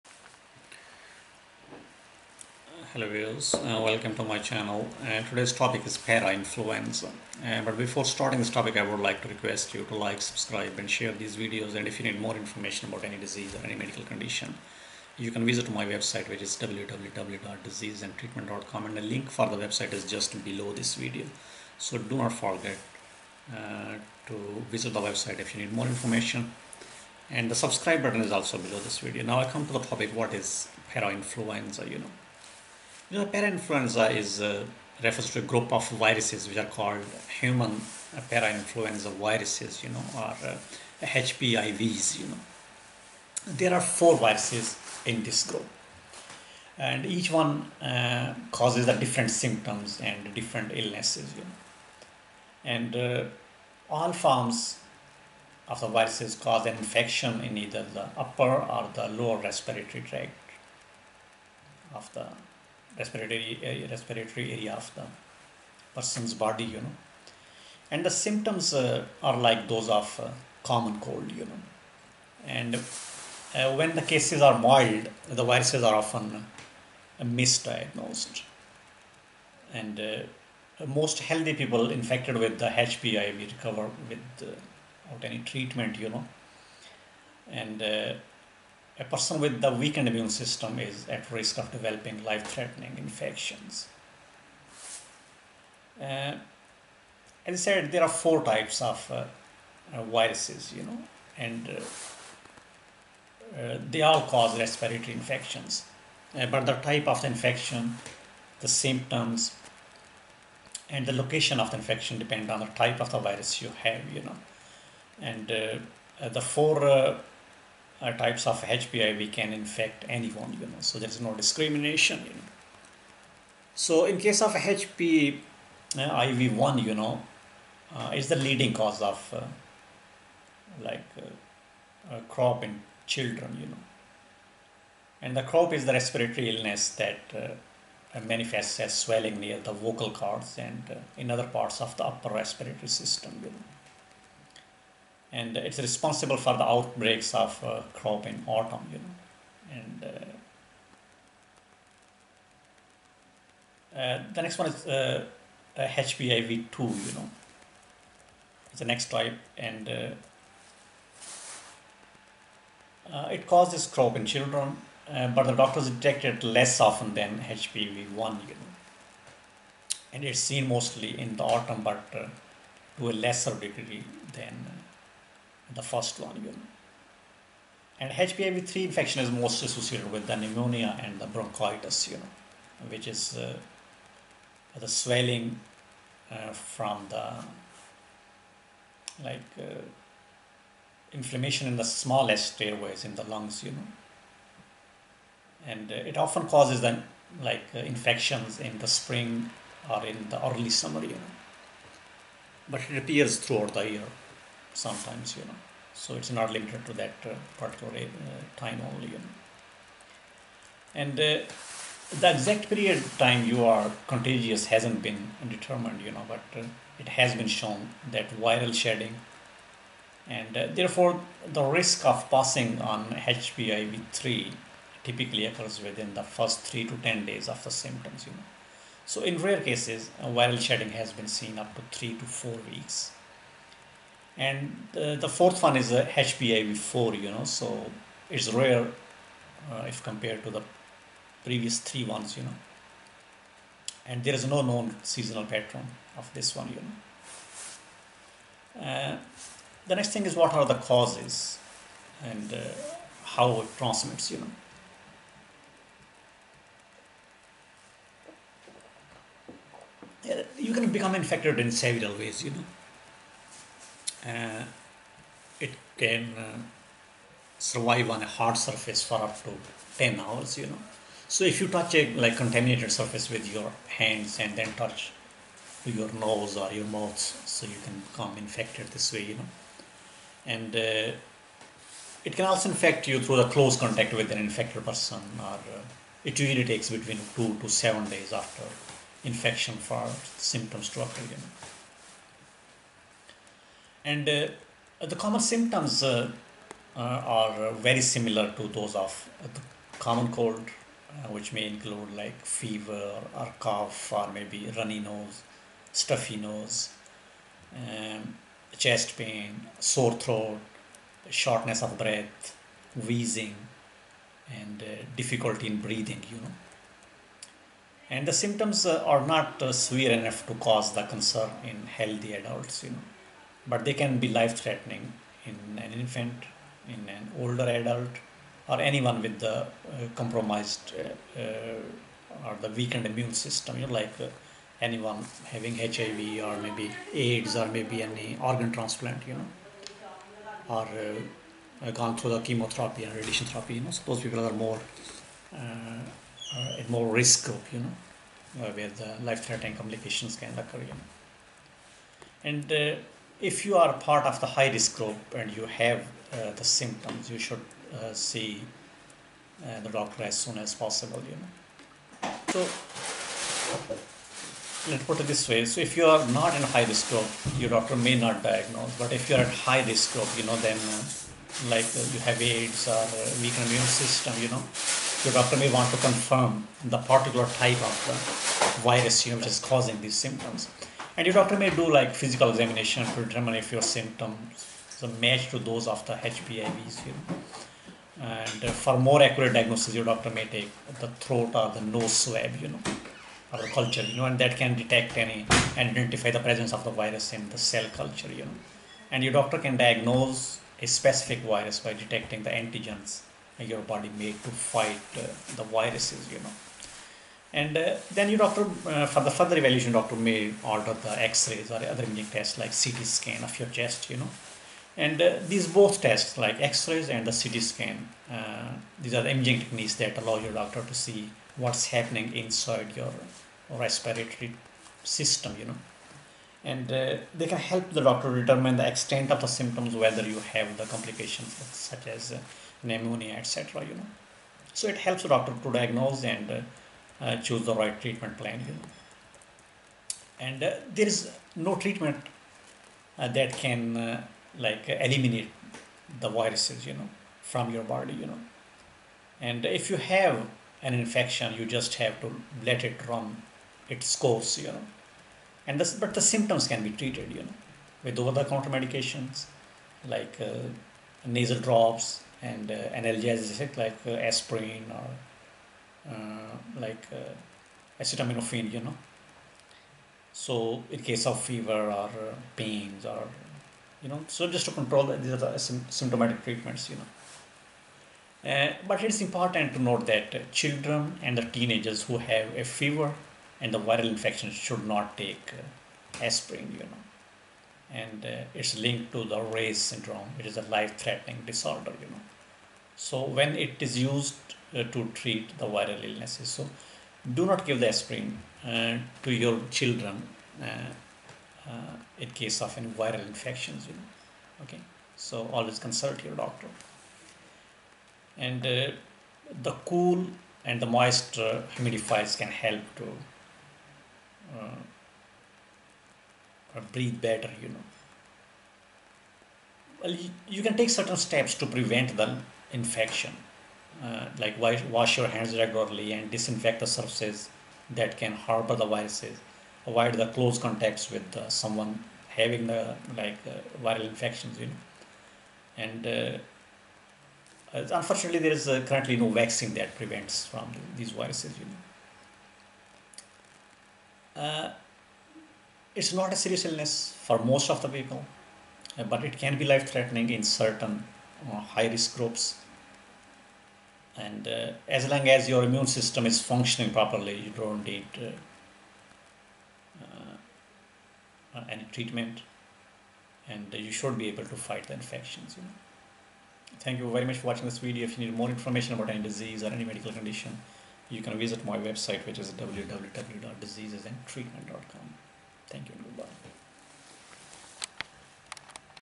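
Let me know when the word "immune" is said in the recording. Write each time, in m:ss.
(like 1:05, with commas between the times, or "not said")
1:30, 5:33, 6:13, 9:15.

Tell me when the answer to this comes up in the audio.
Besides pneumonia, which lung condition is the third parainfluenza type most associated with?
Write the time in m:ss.
3:01.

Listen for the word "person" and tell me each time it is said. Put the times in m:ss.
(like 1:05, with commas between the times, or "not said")
1:05, 1:29, 4:44.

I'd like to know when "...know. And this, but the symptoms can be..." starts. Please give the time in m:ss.
7:34.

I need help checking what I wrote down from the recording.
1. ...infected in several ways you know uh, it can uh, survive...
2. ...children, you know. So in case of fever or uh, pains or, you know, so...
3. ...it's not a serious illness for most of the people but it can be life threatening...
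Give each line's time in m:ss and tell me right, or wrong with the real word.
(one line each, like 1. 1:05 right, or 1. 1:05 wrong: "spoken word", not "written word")
1. 4:21 right
2. 7:48 wrong: "acetaminophen", not "children"
3. 9:05 right.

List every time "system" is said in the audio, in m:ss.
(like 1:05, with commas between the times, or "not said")
1:30, 2:22, 5:33, 6:13, 7:05, 9:15.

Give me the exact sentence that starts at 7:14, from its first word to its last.
So it helps the doctor to diagnose and uh, choose the right treatment plan here.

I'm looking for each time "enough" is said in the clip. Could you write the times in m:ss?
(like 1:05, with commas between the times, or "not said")
5:20.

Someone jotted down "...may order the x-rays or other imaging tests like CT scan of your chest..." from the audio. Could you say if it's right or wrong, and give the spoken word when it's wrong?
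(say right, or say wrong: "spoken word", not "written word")
right.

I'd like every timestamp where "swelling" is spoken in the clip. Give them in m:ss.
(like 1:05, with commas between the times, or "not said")
2:18, 3:04.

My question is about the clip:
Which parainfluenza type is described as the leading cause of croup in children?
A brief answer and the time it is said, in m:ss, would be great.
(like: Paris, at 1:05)
HPIV1, at 2:05.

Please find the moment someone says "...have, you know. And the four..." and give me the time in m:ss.
1:53.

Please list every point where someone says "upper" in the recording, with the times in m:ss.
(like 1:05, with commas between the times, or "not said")
0:58, 2:22.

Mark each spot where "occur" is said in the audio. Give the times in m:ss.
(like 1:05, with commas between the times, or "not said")
3:45, 4:51, 5:50.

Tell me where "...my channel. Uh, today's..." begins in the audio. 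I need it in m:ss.
0:04.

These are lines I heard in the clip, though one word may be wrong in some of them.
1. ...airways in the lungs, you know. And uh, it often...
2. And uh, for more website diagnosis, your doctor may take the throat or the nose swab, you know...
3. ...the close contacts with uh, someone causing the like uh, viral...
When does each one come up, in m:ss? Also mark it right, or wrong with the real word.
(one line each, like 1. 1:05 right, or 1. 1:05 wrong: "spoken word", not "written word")
1. 3:12 right
2. 6:28 wrong: "accurate", not "website"
3. 8:50 wrong: "having", not "causing".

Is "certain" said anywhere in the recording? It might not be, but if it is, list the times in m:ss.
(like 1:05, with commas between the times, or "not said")
8:40, 9:10.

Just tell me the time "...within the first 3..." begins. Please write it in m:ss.
3:45.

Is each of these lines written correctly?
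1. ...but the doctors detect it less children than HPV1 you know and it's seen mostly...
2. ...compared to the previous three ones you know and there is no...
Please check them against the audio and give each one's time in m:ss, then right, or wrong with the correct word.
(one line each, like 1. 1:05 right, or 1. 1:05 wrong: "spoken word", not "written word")
1. 2:45 wrong: "often", not "children"
2. 4:00 right.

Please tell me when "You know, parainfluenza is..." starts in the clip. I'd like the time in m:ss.
0:33.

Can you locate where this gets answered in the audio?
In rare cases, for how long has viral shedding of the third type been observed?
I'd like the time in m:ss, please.
3:51.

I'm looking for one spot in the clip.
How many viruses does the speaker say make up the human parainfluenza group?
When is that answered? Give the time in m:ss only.
0:43.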